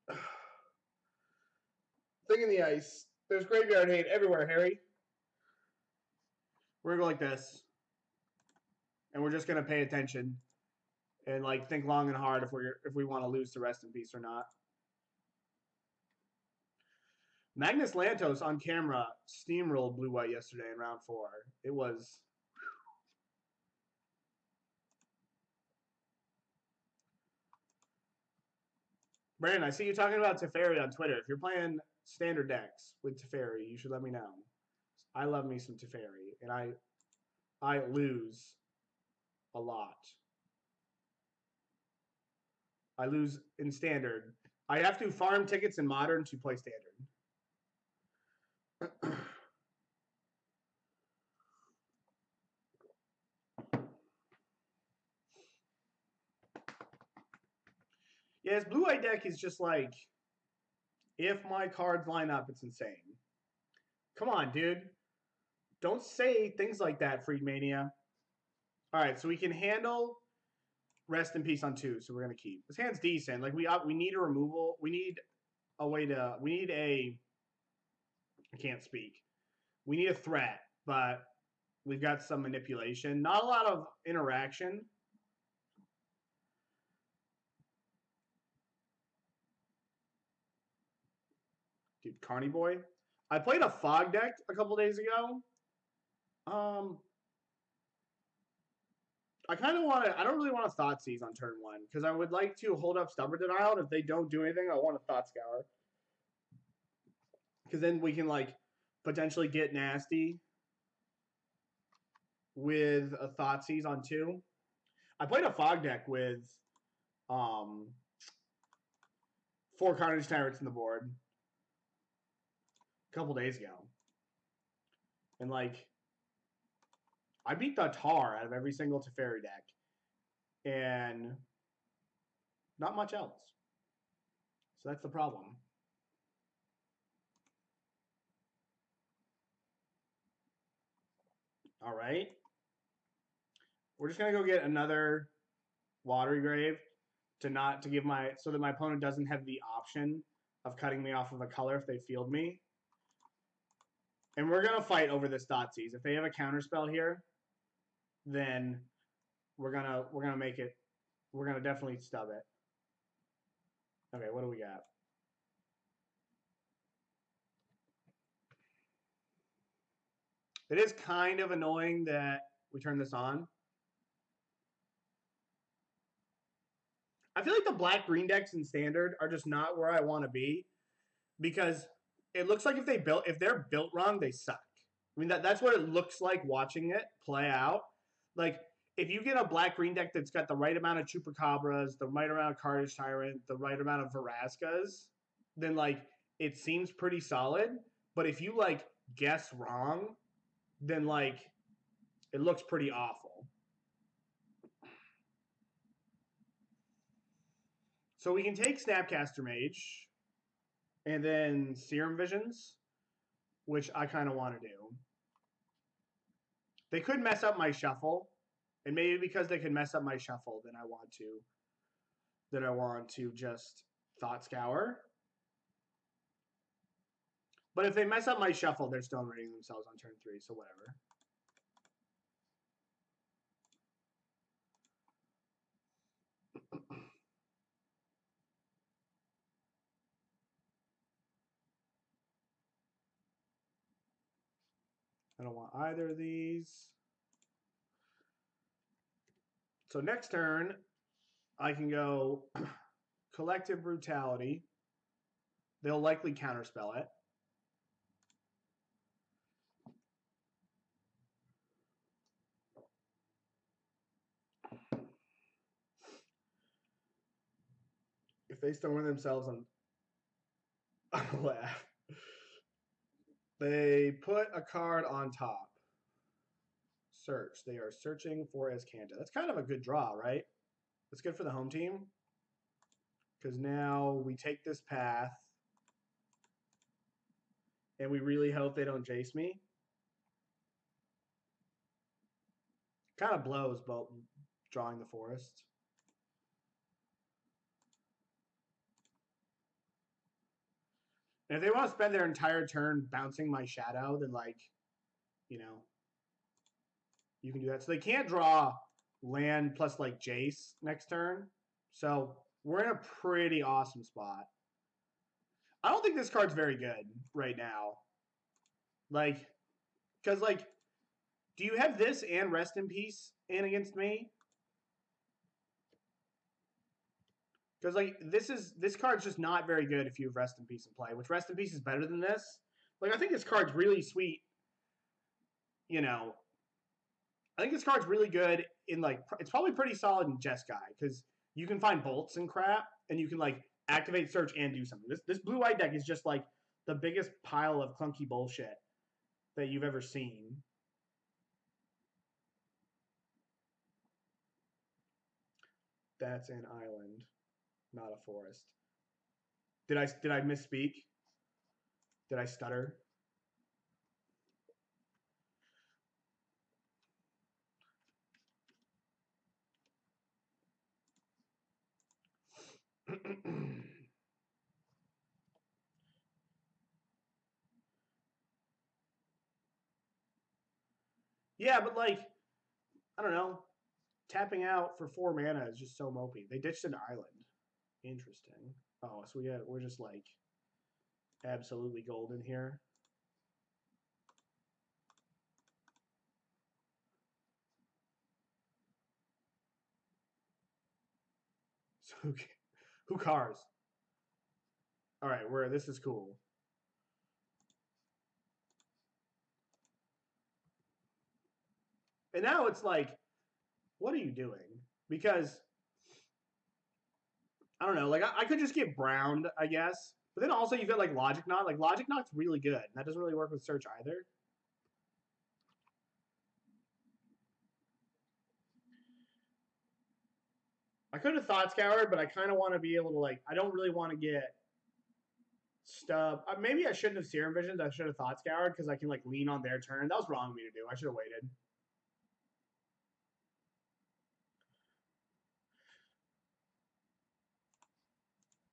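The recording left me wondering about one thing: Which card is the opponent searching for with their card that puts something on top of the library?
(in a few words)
Azcanta.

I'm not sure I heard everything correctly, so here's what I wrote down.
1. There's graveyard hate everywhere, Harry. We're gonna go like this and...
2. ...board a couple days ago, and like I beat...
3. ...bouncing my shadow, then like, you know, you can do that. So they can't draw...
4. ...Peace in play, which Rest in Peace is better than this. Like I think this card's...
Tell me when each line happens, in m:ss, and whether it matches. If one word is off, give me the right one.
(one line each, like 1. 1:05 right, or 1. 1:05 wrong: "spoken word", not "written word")
1. 0:03 right
2. 2:00 right
3. 5:03 right
4. 5:30 right.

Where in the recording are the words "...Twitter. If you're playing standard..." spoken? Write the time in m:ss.
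0:30.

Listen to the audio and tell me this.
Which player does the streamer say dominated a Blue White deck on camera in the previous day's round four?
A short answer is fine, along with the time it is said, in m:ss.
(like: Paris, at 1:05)
Magnus Lantto, at 0:17.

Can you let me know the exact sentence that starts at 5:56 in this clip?
That's an island not a forest.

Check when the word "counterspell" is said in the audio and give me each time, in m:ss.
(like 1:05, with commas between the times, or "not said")
2:36, 4:16.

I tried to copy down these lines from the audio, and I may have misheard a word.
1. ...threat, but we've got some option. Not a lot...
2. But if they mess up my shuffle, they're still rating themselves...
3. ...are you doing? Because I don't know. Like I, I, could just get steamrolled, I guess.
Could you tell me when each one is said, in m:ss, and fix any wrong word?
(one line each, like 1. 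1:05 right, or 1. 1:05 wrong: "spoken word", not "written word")
1. 1:20 wrong: "manipulation", not "option"
2. 3:47 right
3. 6:54 wrong: "browned", not "steamrolled".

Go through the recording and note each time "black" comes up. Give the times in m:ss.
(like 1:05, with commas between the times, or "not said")
2:57, 3:09.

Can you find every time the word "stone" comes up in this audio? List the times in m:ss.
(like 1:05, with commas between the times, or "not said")
4:28.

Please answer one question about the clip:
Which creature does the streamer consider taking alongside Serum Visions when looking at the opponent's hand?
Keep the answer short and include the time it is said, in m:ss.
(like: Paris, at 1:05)
Snapcaster Mage, at 3:28.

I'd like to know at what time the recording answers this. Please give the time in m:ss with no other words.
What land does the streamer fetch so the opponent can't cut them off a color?
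2:26.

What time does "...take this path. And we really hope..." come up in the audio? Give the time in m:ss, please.
4:44.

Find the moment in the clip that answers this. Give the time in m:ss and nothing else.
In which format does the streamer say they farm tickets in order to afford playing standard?
0:45.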